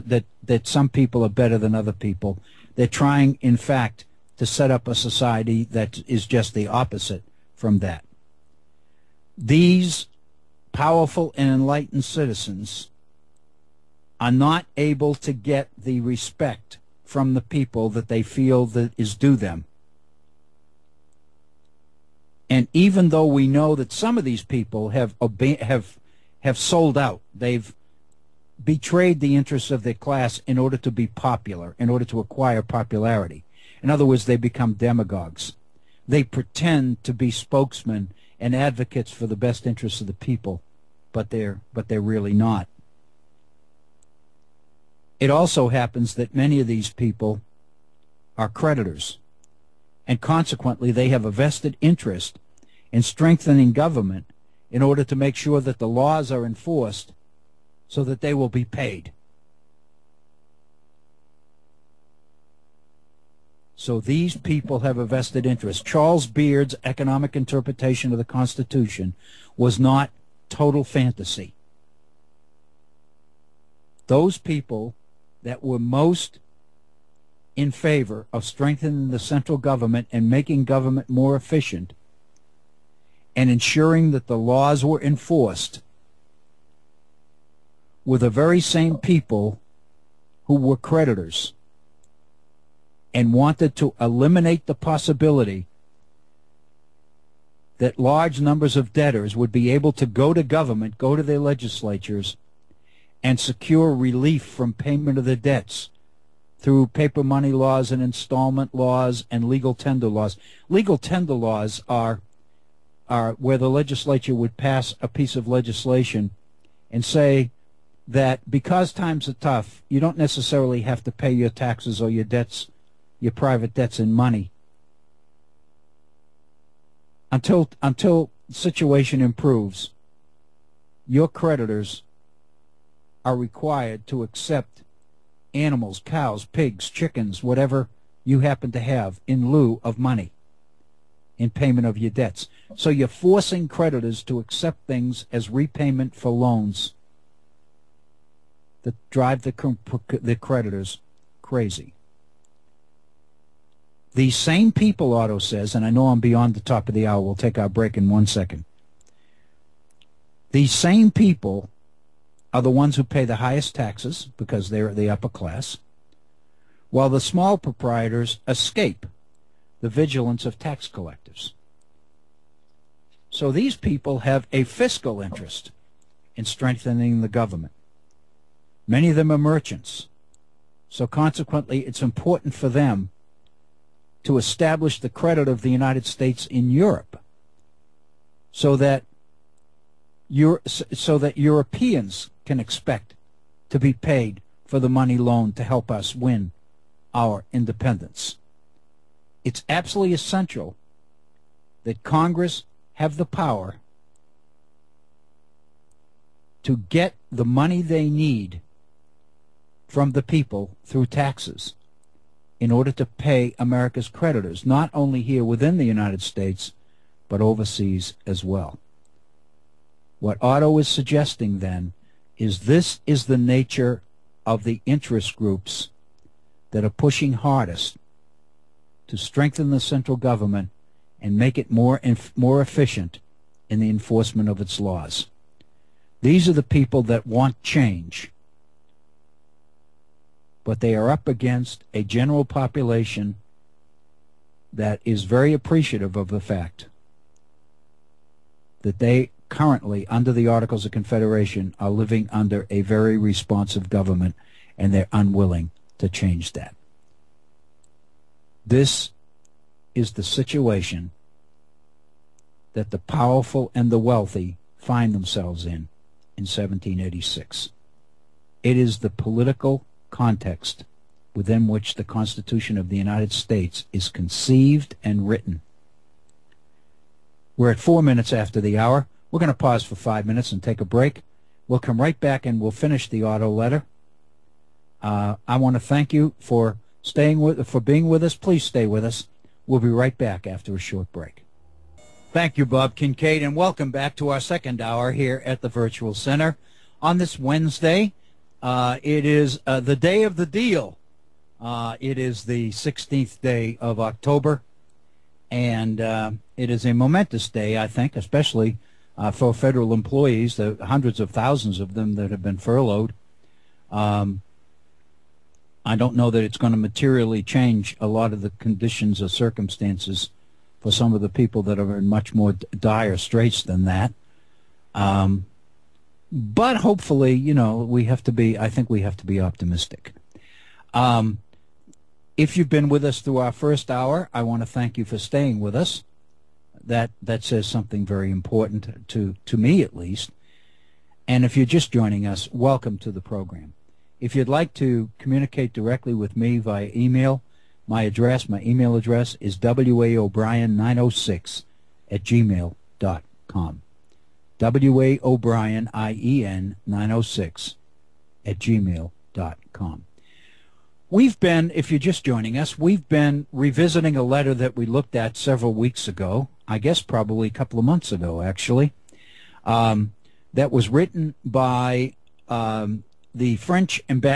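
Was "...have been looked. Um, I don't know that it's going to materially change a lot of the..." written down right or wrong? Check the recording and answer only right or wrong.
wrong.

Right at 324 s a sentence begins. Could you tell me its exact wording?
Um, but hopefully, you know, we have to be, I think we have to be optimistic.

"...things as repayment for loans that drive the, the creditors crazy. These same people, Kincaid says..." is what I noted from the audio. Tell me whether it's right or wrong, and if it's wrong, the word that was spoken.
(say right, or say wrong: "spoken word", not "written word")
wrong: "Otto", not "Kincaid".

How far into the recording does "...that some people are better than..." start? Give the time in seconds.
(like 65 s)
0 s.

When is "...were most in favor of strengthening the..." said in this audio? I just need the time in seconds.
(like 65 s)
75 s.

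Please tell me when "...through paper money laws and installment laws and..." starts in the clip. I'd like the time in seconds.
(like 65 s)
106 s.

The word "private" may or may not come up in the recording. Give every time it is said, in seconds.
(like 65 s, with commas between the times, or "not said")
123 s.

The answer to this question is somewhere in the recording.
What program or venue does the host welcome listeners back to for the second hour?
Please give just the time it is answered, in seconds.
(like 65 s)
295 s.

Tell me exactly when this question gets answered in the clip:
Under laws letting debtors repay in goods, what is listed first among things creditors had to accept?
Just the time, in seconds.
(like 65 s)
135 s.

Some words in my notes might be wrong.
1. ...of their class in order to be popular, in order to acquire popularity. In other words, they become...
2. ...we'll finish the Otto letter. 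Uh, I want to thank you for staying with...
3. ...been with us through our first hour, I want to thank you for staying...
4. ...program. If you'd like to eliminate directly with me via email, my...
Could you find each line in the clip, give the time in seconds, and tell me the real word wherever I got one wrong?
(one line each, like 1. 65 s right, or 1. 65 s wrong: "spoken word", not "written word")
1. 29 s right
2. 282 s right
3. 332 s right
4. 343 s wrong: "communicate", not "eliminate".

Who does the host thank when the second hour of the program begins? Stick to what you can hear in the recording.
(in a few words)
Bob Kincaid.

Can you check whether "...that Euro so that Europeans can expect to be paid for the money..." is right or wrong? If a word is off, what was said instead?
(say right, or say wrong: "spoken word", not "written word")
right.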